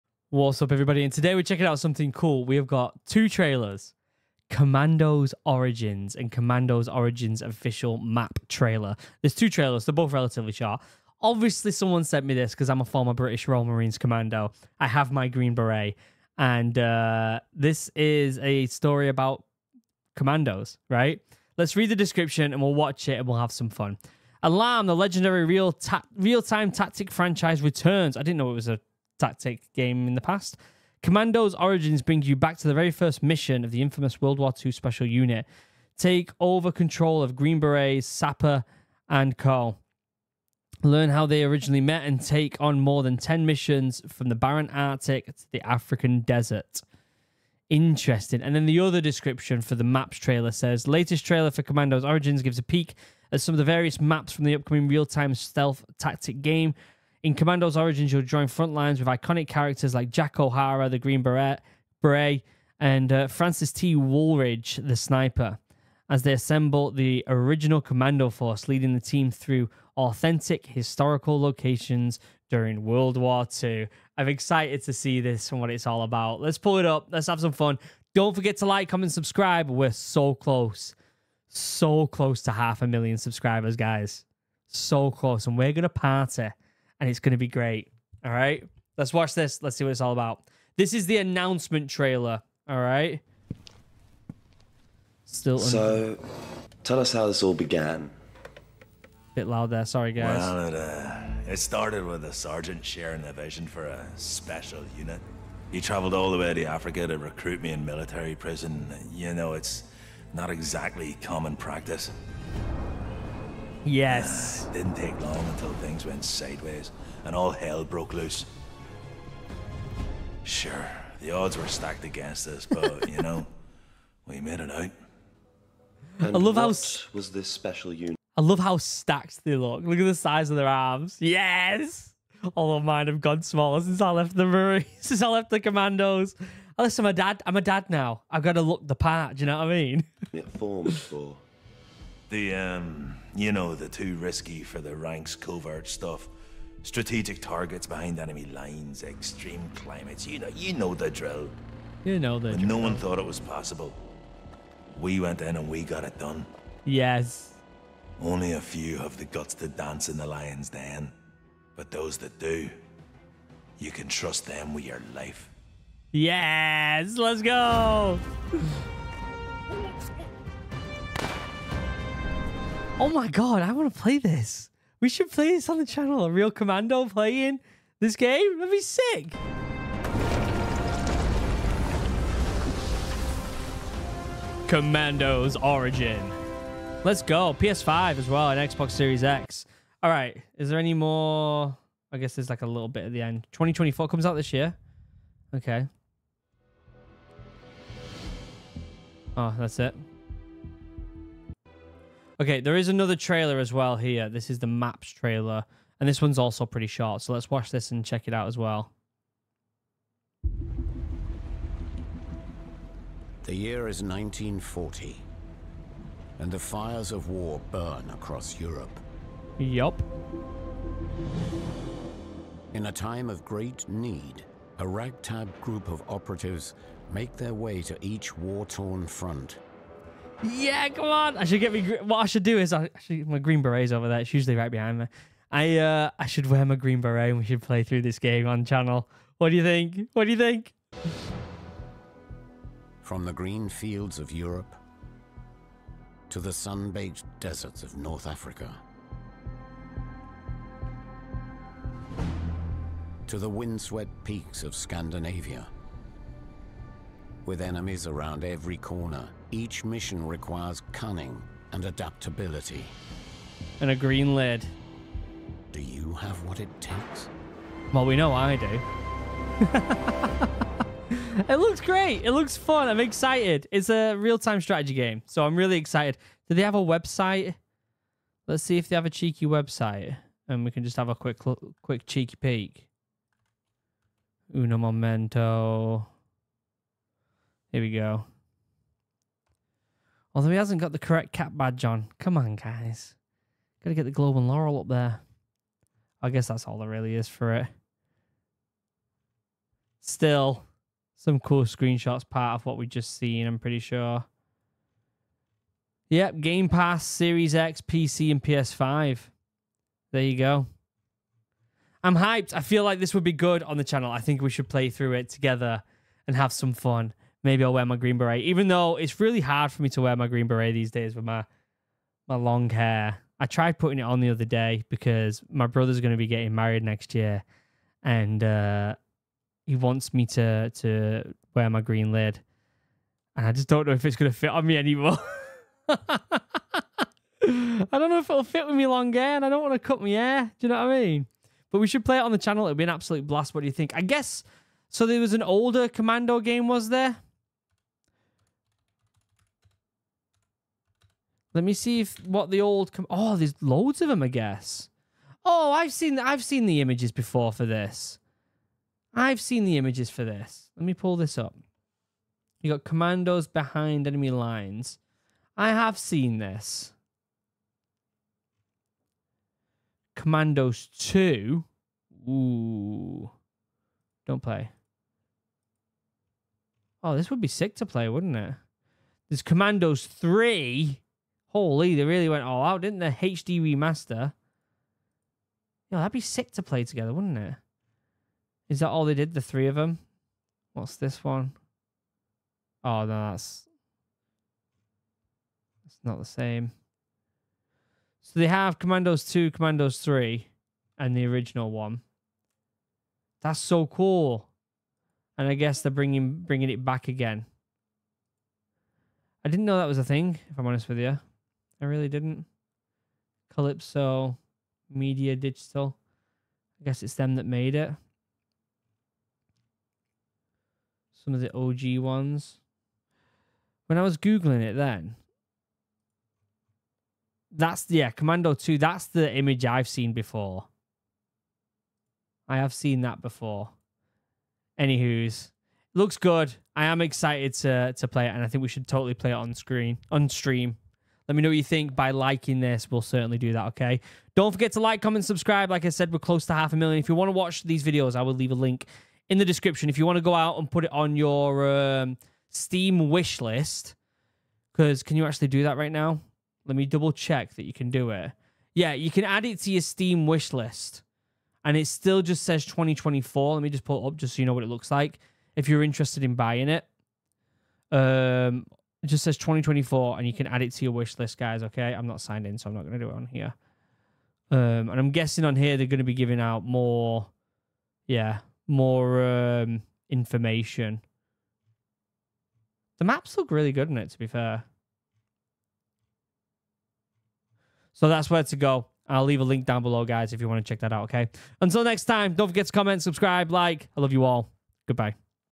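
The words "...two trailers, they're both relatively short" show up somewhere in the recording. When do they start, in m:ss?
0:09.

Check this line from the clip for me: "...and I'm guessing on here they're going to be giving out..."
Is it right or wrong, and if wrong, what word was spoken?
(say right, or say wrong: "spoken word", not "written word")
right.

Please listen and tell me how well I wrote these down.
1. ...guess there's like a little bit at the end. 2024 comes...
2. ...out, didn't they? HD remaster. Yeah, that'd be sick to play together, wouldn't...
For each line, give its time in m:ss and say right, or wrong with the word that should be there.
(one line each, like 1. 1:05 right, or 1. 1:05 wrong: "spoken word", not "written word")
1. 3:12 right
2. 6:22 right.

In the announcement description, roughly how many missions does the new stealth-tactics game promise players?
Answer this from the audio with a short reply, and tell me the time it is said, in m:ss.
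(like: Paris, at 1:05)
more than 10, at 0:42.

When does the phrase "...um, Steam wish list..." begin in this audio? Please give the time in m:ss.
7:31.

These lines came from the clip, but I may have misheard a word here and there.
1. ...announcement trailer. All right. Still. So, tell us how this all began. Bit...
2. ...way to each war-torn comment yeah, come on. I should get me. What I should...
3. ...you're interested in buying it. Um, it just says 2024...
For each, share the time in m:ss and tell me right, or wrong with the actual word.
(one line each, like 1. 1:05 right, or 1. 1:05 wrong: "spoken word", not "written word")
1. 1:31 right
2. 3:47 wrong: "front", not "comment"
3. 7:45 right.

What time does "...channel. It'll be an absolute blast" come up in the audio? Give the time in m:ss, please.
5:42.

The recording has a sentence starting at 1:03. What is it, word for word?
Woolridge, the sniper, as they assemble the original commando force, leading the team through authentic historical locations during World War II.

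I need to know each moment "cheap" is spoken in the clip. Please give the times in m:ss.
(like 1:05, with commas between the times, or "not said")
not said.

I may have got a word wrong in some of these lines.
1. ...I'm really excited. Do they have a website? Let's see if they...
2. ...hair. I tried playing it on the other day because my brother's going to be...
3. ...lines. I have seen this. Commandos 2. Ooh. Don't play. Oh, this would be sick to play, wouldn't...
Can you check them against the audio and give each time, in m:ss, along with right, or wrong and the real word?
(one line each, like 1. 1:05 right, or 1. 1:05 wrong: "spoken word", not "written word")
1. 4:35 right
2. 5:22 wrong: "putting", not "playing"
3. 6:04 right.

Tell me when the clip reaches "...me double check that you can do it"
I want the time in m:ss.
7:36.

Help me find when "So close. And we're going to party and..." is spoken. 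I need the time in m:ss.
1:24.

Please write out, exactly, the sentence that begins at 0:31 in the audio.
Commandos origins brings you back to the very first mission of the infamous World War II Special Unit.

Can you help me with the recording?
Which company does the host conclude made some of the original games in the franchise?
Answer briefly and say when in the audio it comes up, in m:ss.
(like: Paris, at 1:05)
Kalypso Media Digital, at 6:53.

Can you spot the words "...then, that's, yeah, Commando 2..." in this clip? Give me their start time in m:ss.
7:04.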